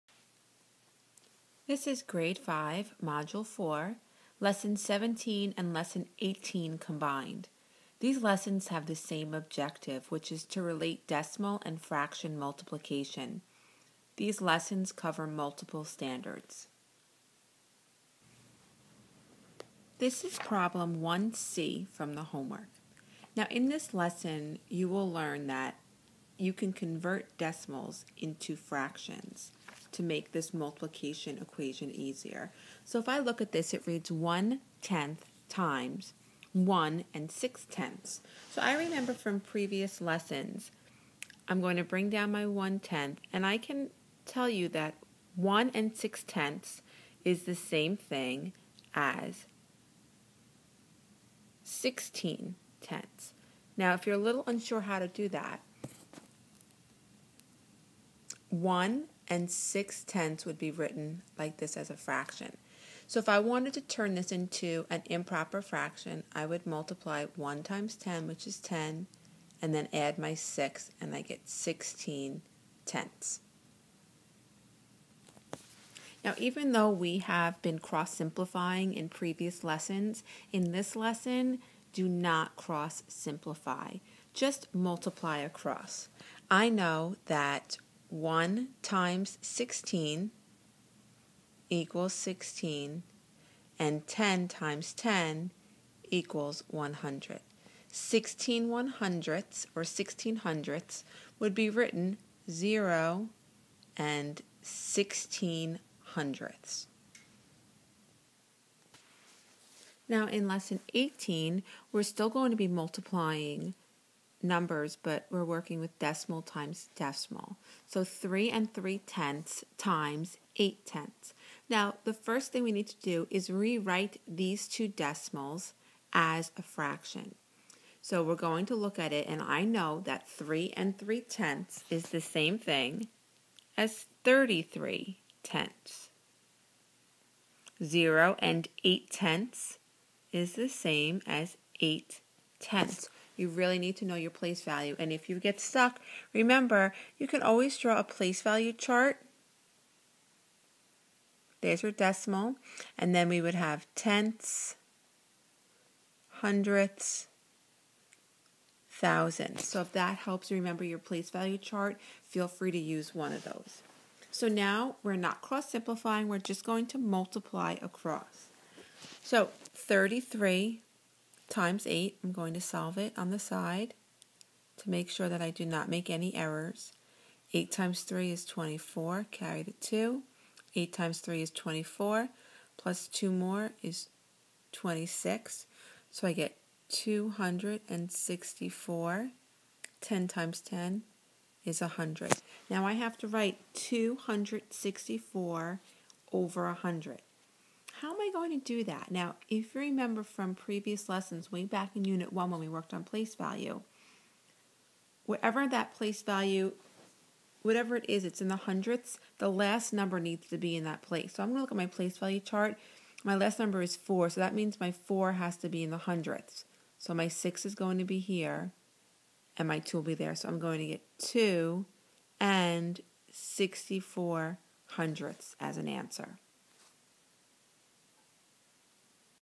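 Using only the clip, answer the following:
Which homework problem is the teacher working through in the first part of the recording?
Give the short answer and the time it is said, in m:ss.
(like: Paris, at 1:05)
1c, at 0:20.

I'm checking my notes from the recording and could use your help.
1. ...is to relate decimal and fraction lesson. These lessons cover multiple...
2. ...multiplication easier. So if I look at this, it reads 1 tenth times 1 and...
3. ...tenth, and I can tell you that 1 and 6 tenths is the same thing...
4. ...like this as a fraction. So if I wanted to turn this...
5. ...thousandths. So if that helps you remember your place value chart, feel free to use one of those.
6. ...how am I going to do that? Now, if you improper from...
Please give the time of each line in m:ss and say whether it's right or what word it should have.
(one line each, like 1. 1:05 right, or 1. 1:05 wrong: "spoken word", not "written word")
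1. 0:10 wrong: "multiplication", not "lesson"
2. 0:31 wrong: "equation", not "multiplication"
3. 0:42 right
4. 1:01 right
5. 2:38 right
6. 3:18 wrong: "remember", not "improper".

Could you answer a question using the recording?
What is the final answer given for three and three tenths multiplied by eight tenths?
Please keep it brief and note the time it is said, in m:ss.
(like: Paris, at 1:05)
2 and 64 hundredths, at 3:41.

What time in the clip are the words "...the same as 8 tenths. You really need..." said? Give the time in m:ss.
2:20.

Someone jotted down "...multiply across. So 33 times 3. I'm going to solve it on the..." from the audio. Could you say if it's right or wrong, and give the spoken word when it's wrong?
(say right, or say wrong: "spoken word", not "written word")
wrong: "8", not "3".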